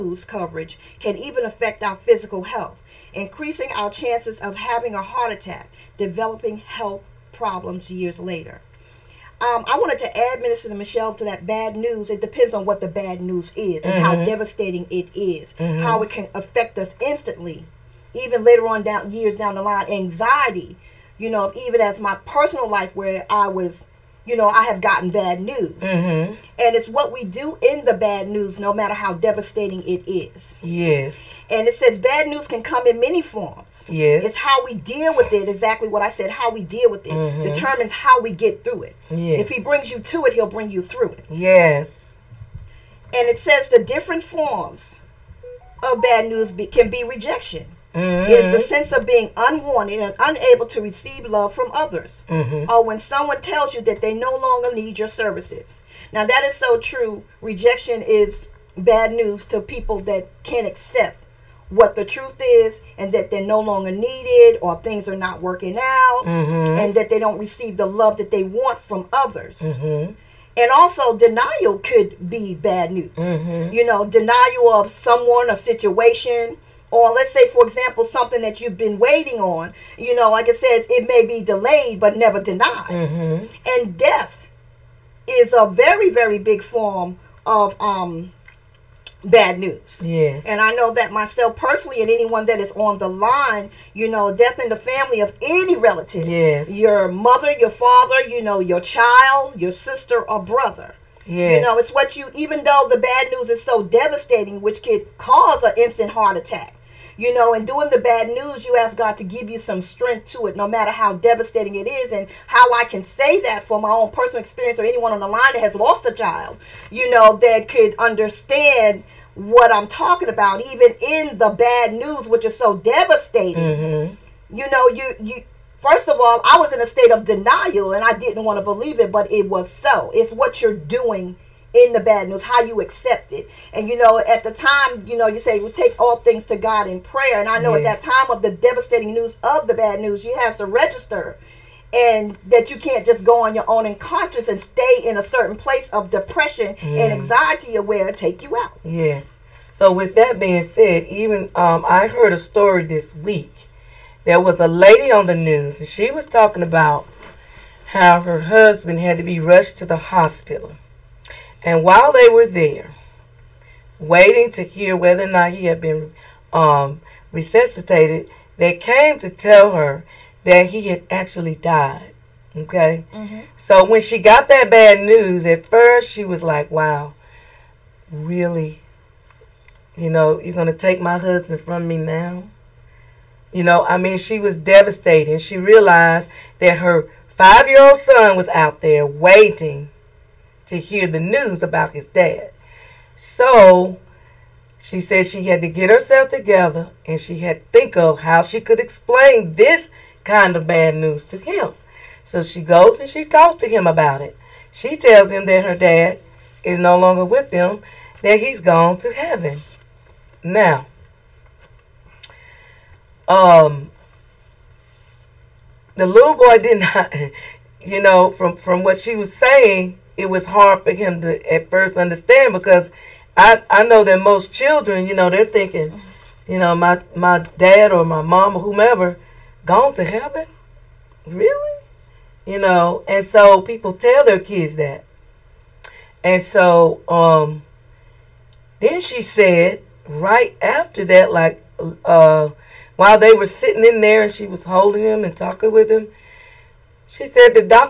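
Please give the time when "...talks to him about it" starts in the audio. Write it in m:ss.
3:23.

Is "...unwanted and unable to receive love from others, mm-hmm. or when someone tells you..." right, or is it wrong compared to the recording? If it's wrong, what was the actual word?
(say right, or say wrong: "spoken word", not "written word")
right.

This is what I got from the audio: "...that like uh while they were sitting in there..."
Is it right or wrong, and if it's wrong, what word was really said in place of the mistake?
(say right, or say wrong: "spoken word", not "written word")
right.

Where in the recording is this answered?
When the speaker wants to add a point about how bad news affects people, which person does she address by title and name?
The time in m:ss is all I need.
0:10.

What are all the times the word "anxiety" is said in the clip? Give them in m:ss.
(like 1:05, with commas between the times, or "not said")
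0:19, 2:27.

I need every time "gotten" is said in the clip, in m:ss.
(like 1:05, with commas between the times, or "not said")
0:24.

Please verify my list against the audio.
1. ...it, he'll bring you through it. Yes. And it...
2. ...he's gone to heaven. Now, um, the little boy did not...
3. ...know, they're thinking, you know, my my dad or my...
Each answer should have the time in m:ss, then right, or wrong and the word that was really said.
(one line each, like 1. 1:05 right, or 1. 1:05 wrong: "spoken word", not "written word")
1. 0:40 right
2. 3:28 right
3. 3:45 right.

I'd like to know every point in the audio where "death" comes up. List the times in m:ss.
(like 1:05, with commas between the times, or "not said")
1:23, 1:34.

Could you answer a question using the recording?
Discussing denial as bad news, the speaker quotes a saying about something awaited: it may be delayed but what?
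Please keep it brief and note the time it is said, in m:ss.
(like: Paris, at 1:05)
never denied, at 1:22.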